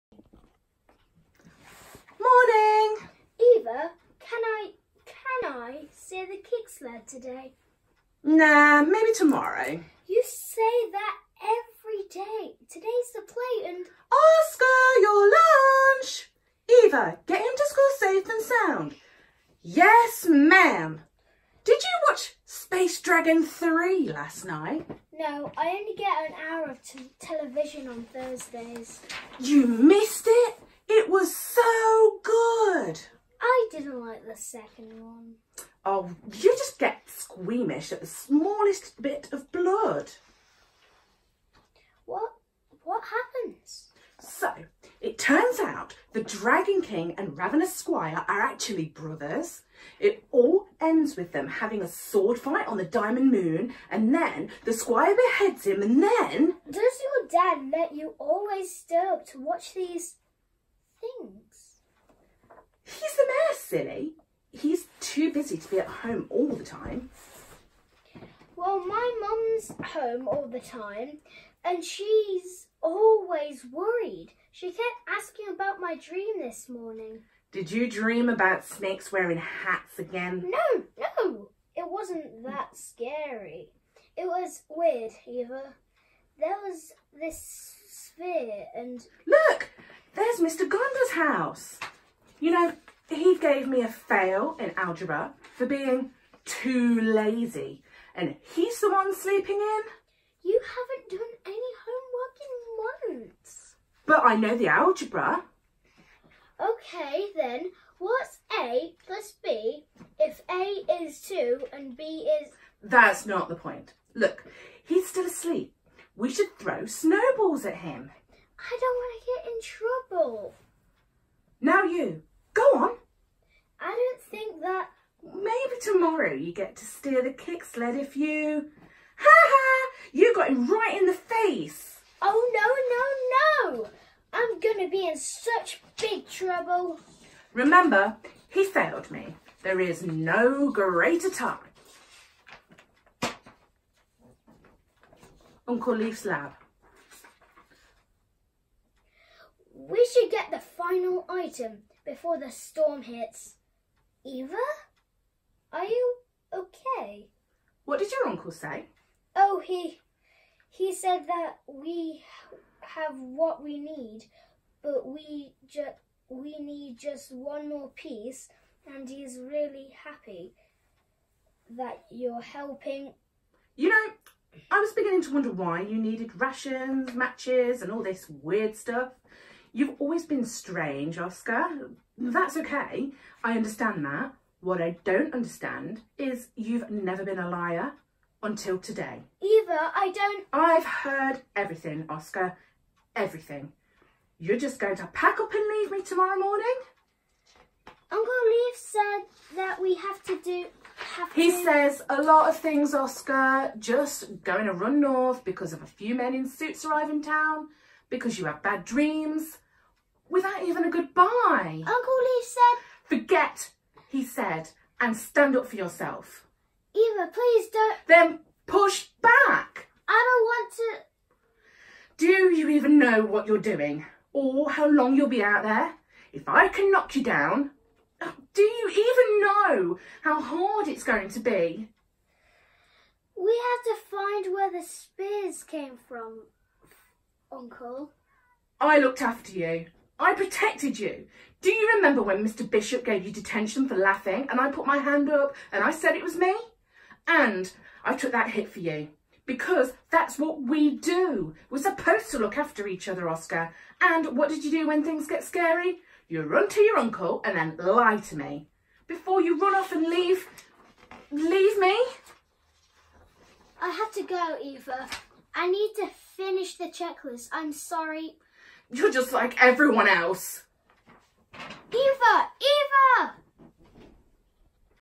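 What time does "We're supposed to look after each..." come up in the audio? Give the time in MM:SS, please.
04:11.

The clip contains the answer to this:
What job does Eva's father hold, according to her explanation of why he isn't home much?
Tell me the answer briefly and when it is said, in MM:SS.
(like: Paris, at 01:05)
Mayor, at 01:03.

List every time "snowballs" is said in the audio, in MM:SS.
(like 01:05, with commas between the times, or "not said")
01:56.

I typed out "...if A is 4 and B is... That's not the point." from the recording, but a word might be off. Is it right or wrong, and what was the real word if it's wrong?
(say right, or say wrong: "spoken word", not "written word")
wrong: "2", not "4".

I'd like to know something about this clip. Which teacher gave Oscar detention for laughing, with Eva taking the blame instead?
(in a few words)
Mr. Bishop.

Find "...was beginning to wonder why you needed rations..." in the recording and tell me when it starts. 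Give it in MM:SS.
02:54.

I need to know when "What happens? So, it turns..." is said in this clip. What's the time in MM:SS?
00:42.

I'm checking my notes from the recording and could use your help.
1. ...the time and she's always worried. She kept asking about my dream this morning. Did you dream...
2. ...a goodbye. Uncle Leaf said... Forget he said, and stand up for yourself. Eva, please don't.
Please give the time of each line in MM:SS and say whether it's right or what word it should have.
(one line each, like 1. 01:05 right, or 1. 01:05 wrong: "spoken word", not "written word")
1. 01:10 right
2. 03:30 right.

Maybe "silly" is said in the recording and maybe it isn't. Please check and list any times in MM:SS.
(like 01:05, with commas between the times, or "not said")
01:03.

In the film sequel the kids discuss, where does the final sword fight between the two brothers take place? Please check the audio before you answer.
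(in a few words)
The Diamond Moon.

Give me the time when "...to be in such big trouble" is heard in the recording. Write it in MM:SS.
02:14.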